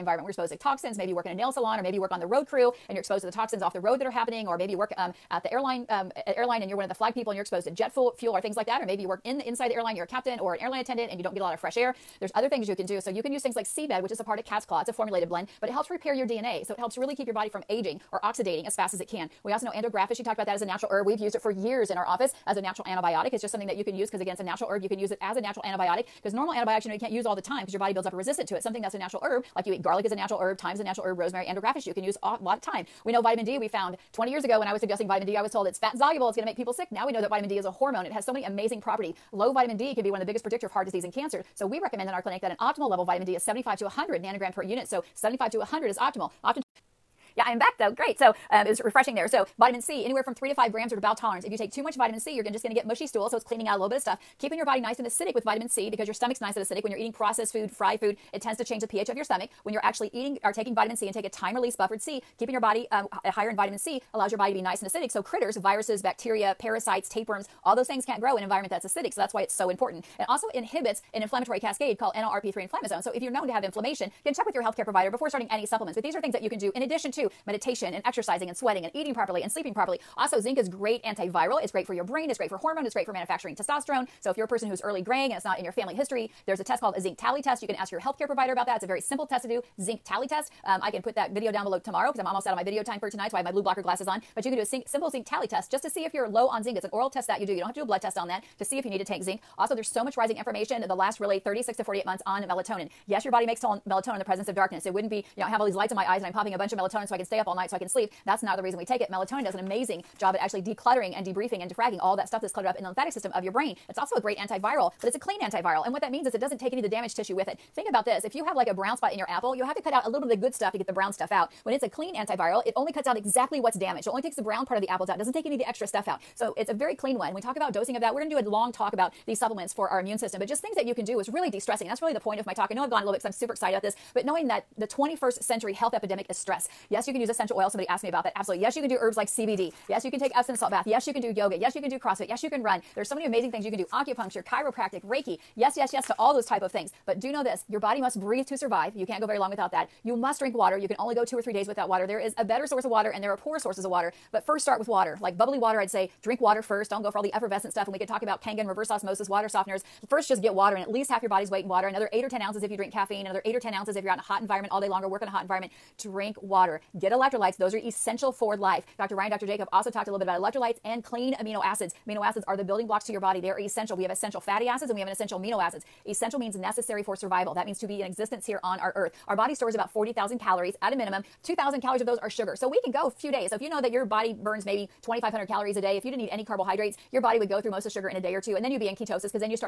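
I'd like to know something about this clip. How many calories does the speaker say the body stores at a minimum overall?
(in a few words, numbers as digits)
40,000.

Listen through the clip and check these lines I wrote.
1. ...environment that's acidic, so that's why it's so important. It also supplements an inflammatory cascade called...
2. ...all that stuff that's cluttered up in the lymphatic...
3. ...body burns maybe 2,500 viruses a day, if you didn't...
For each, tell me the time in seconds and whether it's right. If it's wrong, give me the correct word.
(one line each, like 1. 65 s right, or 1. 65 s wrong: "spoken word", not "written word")
1. 68 s wrong: "inhibits", not "supplements"
2. 112 s right
3. 184 s wrong: "calories", not "viruses".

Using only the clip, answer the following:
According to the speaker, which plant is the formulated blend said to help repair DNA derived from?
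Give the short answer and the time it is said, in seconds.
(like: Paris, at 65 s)
cat's claw, at 14 s.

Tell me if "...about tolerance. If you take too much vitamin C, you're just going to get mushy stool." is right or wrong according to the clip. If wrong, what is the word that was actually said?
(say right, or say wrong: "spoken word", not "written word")
right.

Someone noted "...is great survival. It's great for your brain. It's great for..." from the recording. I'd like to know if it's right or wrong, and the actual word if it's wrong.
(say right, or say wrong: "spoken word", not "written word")
wrong: "antiviral", not "survival".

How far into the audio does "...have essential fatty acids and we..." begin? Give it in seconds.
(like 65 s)
174 s.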